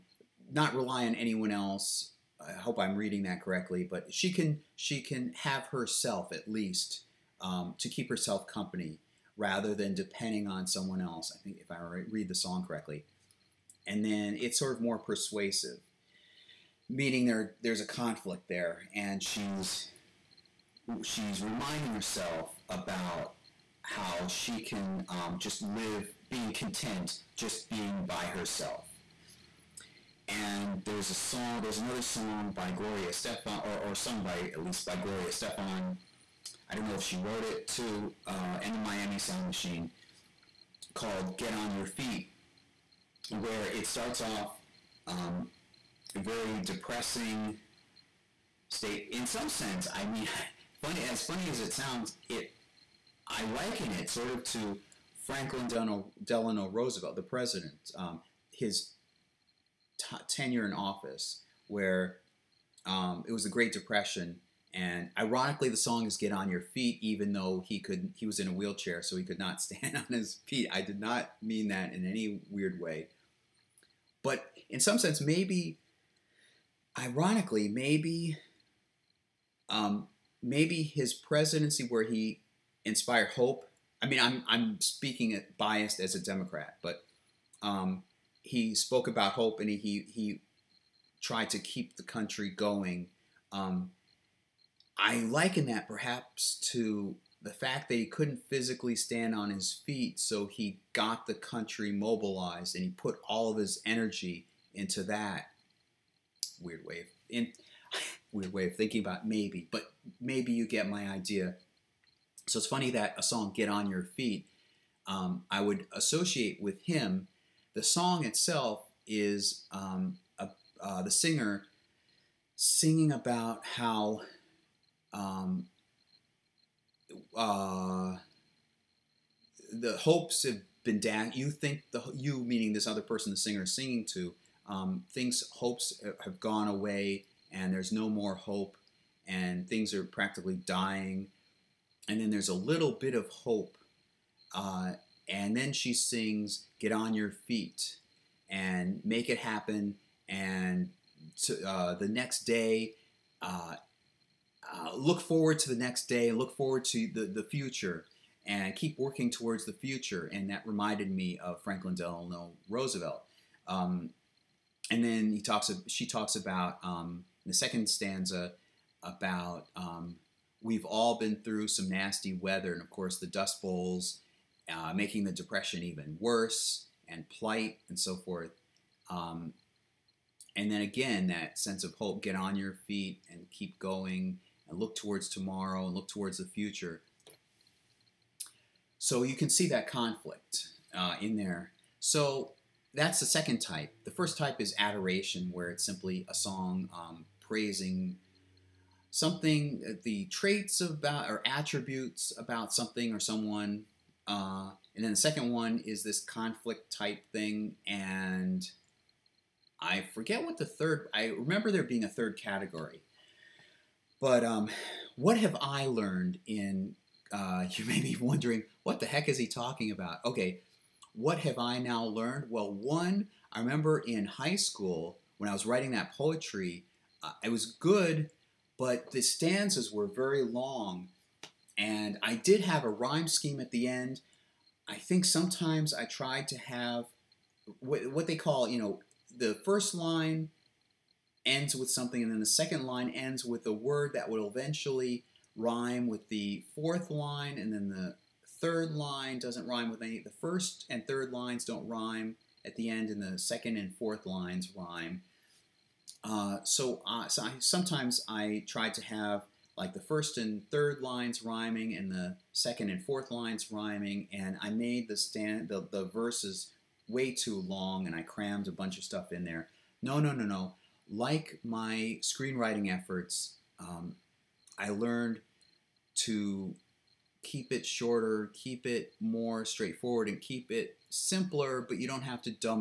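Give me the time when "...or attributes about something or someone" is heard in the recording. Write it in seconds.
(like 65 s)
201 s.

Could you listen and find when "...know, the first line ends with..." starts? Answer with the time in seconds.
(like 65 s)
238 s.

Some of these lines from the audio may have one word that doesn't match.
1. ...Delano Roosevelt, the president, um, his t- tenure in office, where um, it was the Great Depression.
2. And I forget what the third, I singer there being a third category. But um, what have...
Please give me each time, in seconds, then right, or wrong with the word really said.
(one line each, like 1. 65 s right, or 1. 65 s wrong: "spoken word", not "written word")
1. 56 s right
2. 207 s wrong: "remember", not "singer".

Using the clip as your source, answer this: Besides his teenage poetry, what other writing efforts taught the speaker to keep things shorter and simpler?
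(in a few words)
Screenwriting.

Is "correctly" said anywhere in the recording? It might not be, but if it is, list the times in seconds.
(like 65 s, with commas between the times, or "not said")
3 s, 12 s.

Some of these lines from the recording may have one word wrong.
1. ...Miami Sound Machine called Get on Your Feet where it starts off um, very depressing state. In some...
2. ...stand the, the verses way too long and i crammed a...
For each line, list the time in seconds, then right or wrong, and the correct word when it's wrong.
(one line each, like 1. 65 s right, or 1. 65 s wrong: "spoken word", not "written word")
1. 38 s right
2. 265 s right.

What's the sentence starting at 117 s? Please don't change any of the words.
The song itself is um, a, uh, the singer singing about how um, uh, the hopes have been down.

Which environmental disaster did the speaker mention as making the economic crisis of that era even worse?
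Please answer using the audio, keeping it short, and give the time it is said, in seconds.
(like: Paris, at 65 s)
Dust bowls, at 173 s.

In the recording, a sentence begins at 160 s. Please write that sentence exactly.
And that reminded me of Franklin Delano Roosevelt.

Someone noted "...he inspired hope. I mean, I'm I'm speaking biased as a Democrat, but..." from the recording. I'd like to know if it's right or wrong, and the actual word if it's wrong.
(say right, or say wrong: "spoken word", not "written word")
right.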